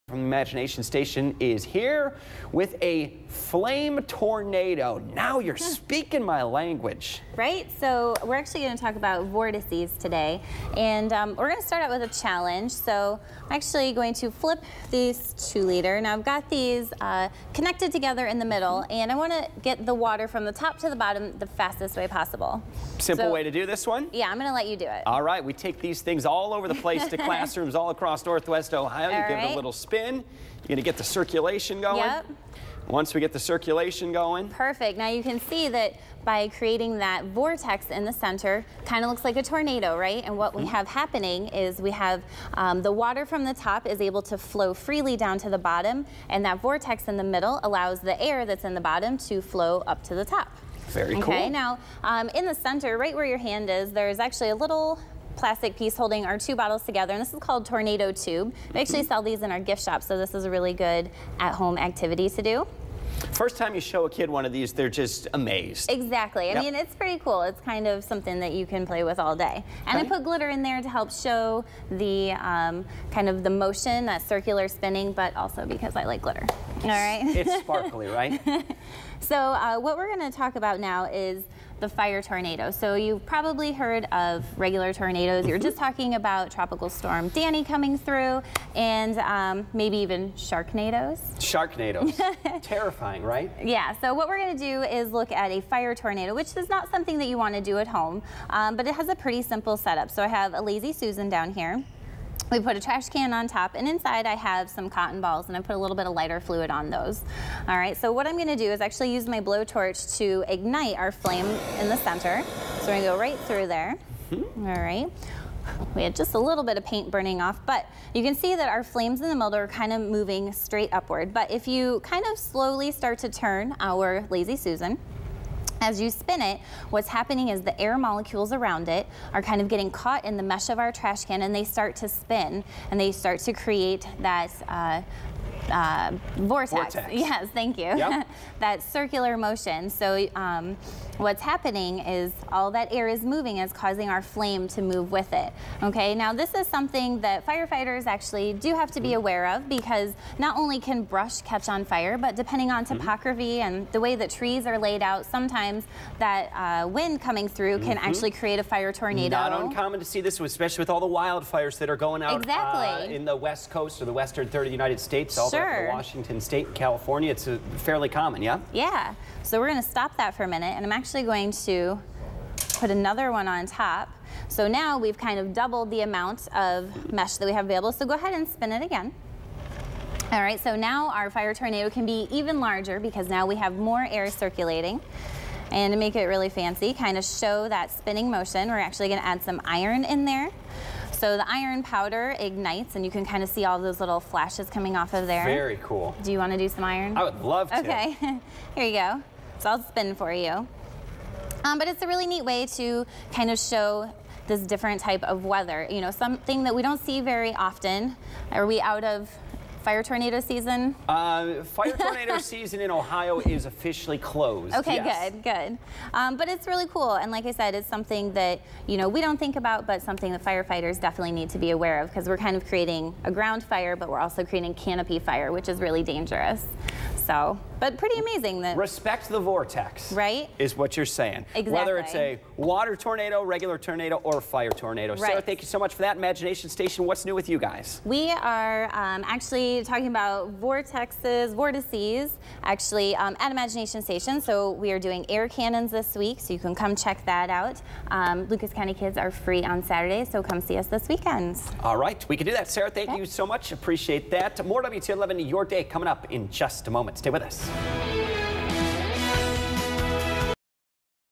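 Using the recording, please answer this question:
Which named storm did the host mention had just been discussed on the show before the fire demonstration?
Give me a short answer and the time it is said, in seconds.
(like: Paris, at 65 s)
Tropical Storm Danny, at 86 s.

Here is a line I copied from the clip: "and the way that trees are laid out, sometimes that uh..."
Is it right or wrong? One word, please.
right.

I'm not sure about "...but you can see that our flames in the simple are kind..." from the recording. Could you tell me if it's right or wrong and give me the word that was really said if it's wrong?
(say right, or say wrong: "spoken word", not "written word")
wrong: "middle", not "simple".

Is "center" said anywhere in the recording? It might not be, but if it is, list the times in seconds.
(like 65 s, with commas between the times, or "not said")
38 s, 52 s, 111 s.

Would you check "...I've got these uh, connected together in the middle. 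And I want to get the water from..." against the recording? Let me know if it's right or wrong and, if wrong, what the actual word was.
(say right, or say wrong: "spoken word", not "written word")
right.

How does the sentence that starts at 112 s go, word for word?
So we're gonna go right through there.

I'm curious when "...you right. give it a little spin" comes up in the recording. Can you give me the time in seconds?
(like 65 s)
29 s.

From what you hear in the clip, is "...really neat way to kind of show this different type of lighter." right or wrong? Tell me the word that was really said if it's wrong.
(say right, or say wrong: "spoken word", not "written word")
wrong: "weather", not "lighter".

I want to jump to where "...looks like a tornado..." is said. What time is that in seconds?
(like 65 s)
39 s.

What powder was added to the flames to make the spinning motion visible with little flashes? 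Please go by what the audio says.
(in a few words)
Iron powder.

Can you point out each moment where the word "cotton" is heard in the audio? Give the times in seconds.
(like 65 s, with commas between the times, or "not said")
104 s.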